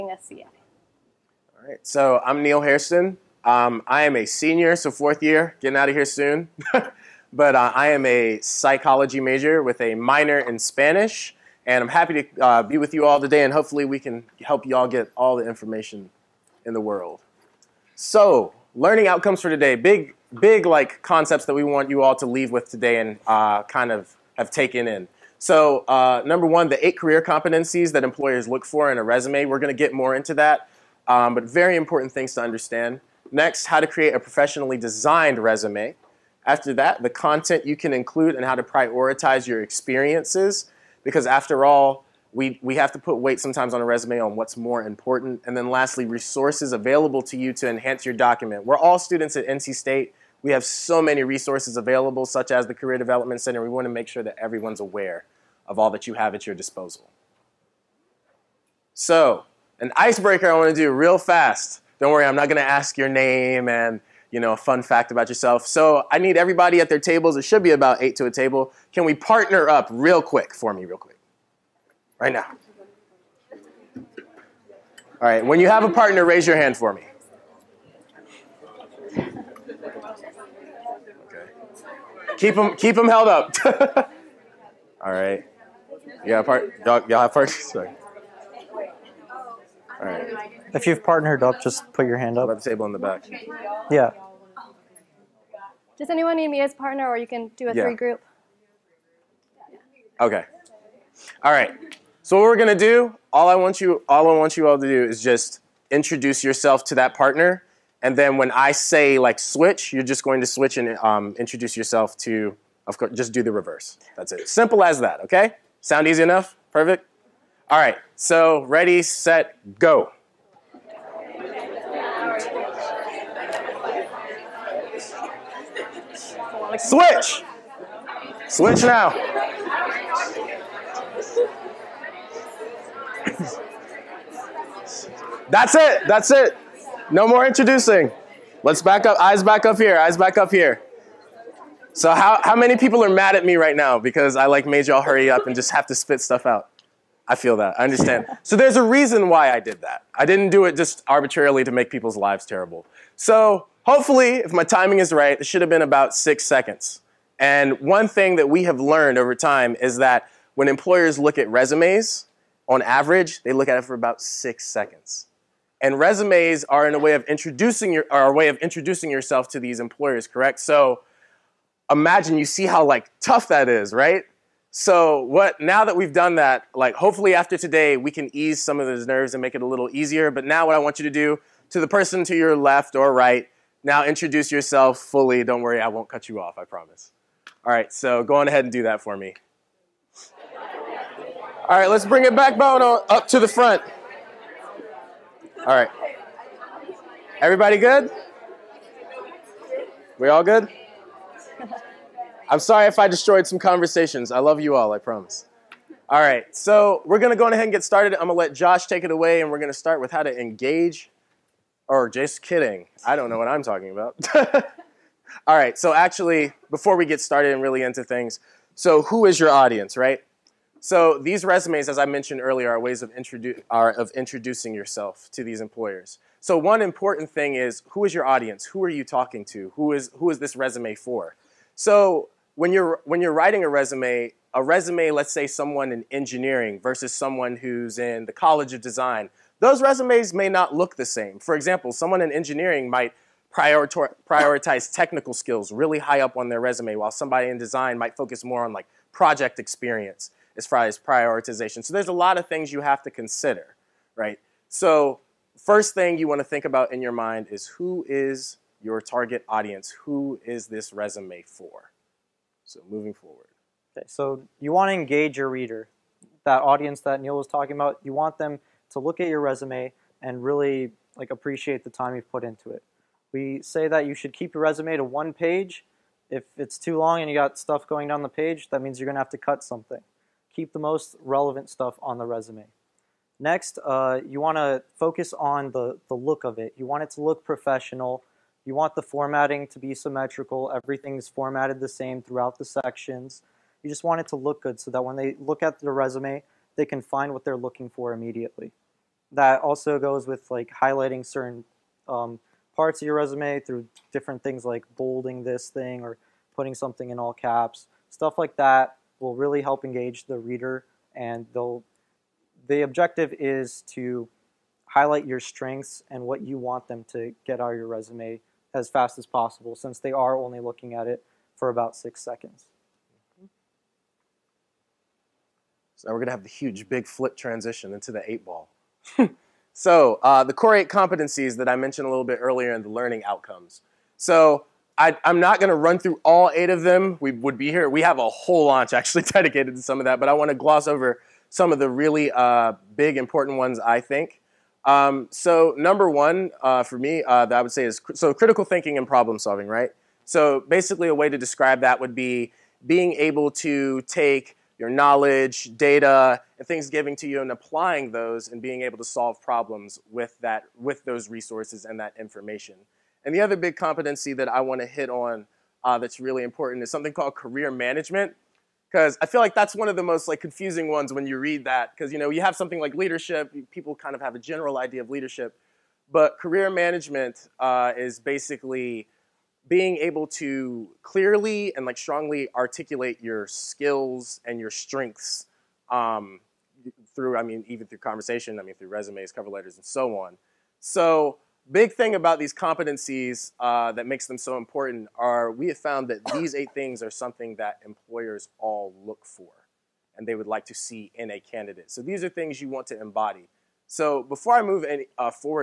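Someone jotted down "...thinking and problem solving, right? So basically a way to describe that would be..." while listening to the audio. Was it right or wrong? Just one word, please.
right.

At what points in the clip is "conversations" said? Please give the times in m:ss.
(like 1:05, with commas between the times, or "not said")
3:23, 6:27.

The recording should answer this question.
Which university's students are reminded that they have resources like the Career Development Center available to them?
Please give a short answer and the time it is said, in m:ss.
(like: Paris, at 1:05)
NC State, at 0:49.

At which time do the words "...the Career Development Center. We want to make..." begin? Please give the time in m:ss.
0:52.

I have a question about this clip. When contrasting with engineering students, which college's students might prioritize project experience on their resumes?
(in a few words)
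College of Design.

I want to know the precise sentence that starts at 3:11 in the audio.
All right, let's bring it back, Bono, up to the front.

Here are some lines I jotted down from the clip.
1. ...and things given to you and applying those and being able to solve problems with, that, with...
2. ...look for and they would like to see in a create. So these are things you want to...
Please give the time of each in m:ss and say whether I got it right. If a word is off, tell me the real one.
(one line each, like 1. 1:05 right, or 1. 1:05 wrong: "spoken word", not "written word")
1. 5:56 right
2. 6:39 wrong: "candidate", not "create".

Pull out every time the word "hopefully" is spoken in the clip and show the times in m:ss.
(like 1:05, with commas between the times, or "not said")
0:13, 2:33, 2:56.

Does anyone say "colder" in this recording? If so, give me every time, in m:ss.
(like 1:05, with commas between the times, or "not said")
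not said.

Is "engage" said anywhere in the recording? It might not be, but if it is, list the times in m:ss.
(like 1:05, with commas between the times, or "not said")
3:30, 4:24, 5:09.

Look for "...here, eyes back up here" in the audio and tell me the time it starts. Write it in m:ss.
2:19.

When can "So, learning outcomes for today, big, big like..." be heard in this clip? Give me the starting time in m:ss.
0:17.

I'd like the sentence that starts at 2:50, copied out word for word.
So imagine you see how like tough that is, right?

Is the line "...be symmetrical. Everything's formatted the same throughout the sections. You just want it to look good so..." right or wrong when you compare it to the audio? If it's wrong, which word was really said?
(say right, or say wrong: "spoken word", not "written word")
right.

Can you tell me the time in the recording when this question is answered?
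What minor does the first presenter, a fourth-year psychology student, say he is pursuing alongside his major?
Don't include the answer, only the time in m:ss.
0:10.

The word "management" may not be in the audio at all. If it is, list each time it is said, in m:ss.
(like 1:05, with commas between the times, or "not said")
6:07, 6:16.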